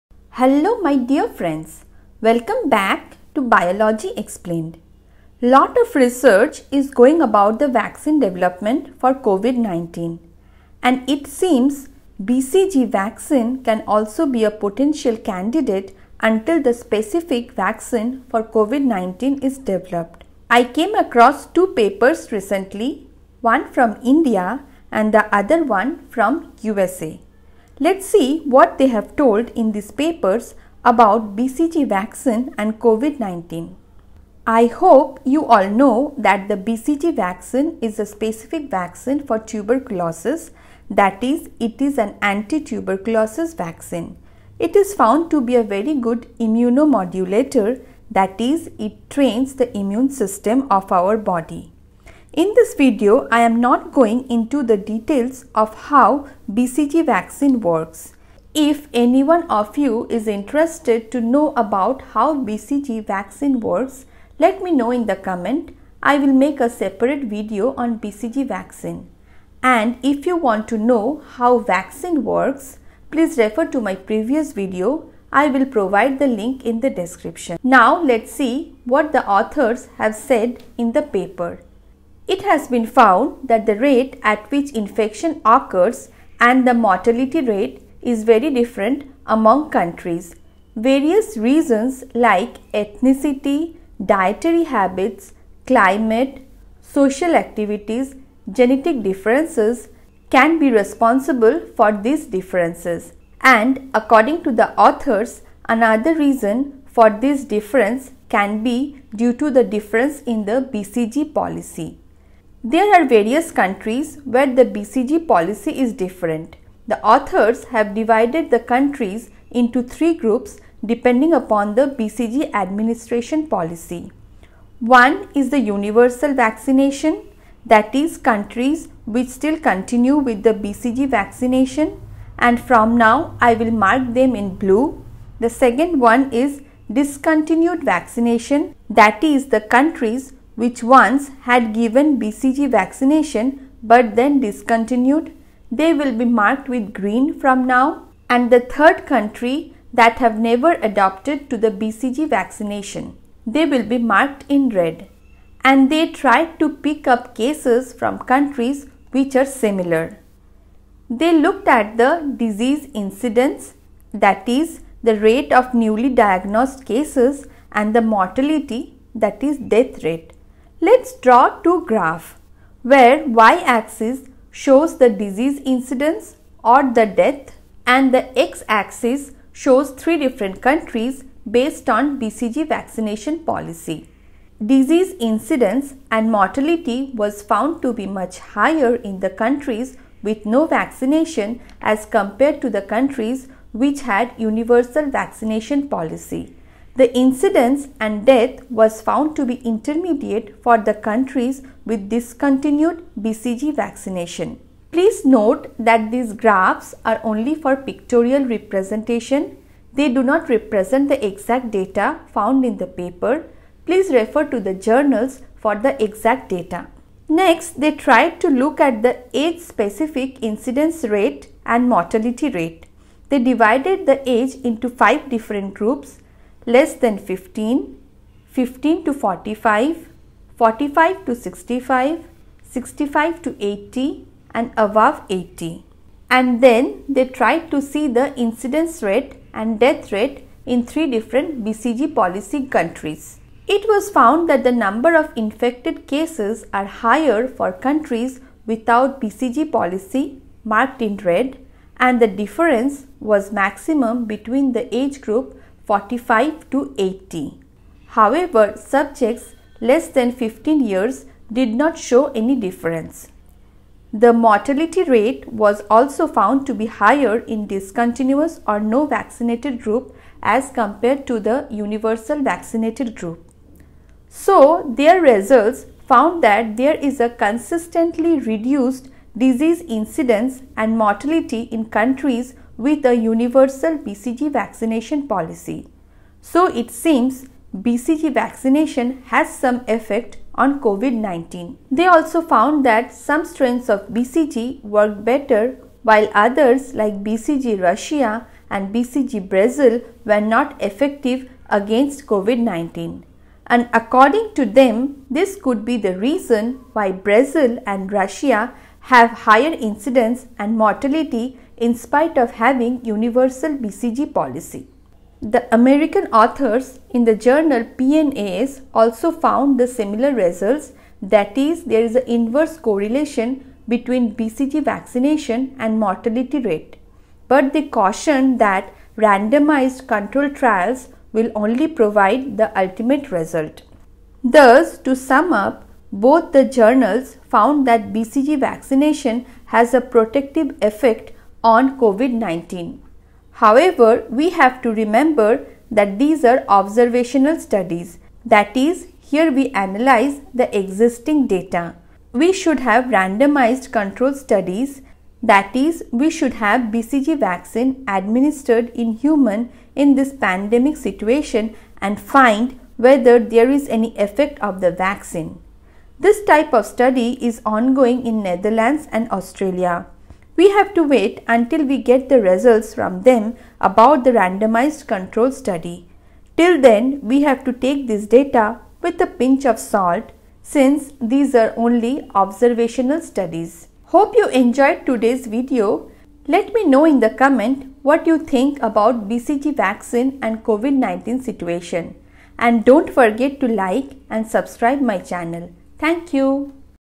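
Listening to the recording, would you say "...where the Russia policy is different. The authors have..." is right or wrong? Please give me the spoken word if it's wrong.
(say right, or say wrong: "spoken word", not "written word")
wrong: "BCG", not "Russia".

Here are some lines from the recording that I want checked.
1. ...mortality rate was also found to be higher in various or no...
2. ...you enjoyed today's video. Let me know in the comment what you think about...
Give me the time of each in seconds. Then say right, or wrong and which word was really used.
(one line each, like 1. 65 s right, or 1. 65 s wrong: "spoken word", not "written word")
1. 264 s wrong: "discontinuous", not "various"
2. 384 s right.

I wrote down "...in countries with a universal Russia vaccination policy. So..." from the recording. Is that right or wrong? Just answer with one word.
wrong.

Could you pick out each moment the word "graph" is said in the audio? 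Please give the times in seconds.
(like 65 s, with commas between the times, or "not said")
171 s, 206 s.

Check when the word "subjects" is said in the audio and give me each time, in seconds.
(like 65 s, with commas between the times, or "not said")
258 s.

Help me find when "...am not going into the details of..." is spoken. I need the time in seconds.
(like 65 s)
53 s.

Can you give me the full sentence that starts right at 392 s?
And don't forget to like and subscribe my channel.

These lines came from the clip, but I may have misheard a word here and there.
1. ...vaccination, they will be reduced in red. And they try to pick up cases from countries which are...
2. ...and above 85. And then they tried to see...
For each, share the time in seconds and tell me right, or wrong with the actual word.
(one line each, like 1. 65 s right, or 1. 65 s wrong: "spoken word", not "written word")
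1. 152 s wrong: "marked", not "reduced"
2. 234 s wrong: "80", not "85".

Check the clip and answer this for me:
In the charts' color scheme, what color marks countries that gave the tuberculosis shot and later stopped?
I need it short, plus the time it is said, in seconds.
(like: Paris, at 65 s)
Green, at 146 s.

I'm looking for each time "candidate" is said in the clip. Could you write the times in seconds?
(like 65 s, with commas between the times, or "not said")
15 s.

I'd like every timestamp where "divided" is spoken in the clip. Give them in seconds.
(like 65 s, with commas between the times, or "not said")
117 s, 223 s.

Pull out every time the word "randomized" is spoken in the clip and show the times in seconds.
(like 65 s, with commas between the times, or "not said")
329 s, 353 s, 374 s.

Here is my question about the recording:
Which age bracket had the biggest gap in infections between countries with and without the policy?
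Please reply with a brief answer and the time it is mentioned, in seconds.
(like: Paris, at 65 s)
45 to 80, at 255 s.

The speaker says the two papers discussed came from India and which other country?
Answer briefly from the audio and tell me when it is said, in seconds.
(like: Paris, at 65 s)
USA, at 26 s.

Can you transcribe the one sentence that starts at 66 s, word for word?
I will make a separate video on BCG vaccine.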